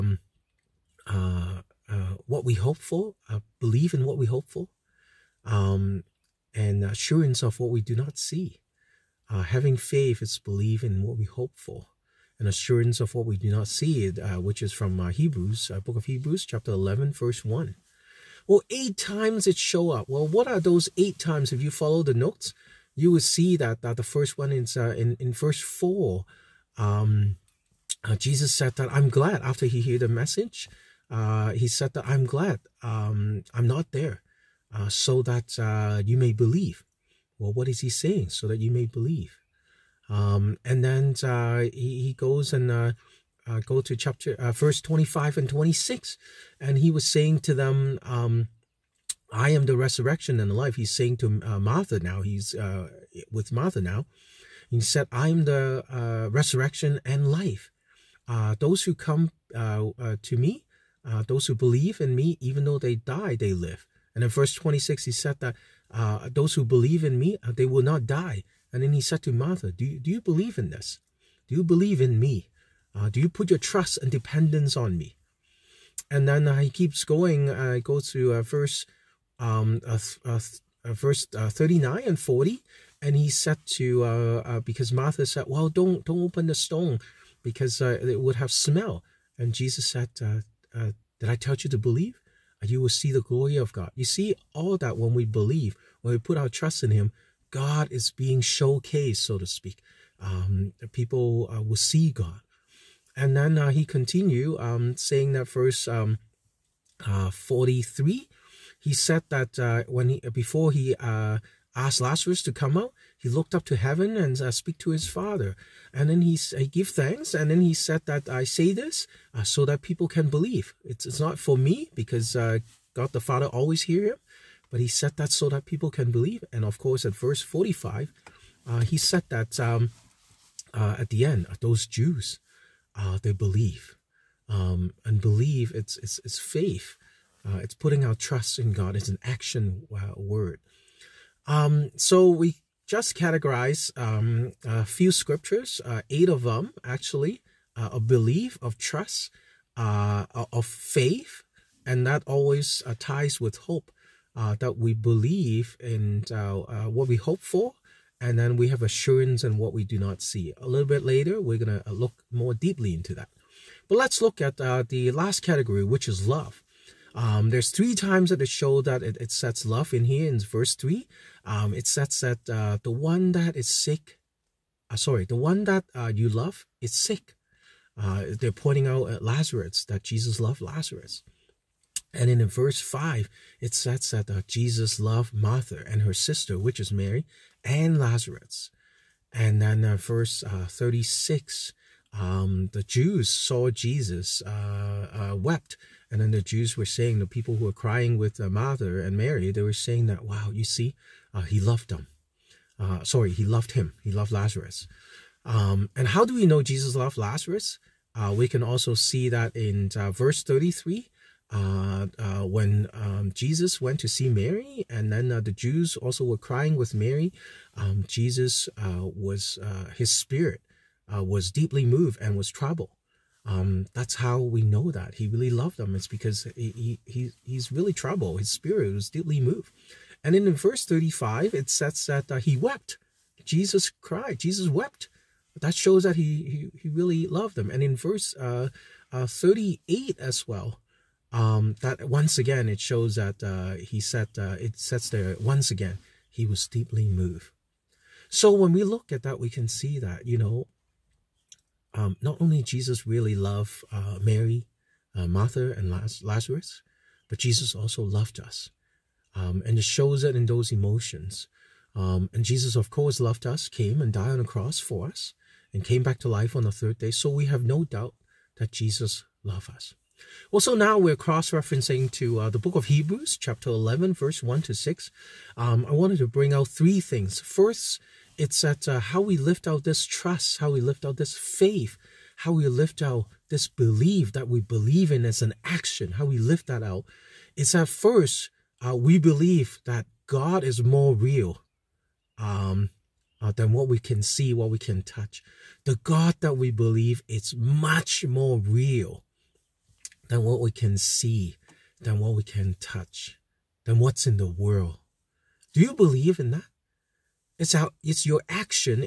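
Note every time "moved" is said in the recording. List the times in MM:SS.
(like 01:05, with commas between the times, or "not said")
03:41, 03:49, 04:07.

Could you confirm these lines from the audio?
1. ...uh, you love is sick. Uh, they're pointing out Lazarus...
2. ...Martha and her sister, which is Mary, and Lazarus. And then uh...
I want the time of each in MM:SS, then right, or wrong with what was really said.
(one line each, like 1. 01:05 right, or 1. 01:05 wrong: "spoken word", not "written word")
1. 02:55 right
2. 03:05 right.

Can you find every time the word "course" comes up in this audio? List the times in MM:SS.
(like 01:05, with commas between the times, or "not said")
02:06, 04:22.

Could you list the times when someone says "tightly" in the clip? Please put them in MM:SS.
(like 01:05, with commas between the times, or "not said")
not said.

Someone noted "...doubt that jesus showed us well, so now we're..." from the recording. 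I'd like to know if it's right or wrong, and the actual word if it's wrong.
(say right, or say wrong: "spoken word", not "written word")
wrong: "loved", not "showed".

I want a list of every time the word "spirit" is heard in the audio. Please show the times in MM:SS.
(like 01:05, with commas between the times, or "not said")
03:40, 03:48.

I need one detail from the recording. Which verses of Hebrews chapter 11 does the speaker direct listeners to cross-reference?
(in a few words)
1 to 6.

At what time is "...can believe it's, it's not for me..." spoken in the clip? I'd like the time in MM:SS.
02:00.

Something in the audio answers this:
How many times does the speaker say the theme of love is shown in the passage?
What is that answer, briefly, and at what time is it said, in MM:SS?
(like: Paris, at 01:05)
3, at 02:47.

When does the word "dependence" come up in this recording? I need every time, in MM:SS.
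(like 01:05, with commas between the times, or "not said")
01:14.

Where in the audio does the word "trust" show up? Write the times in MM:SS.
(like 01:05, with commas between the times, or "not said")
01:13, 01:36, 02:18, 02:28, 04:40.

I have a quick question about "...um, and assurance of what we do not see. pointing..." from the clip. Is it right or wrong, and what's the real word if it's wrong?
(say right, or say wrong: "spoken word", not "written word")
wrong: "having", not "pointing".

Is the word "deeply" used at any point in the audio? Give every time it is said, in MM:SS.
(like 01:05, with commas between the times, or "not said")
02:42, 03:41, 03:49, 04:06.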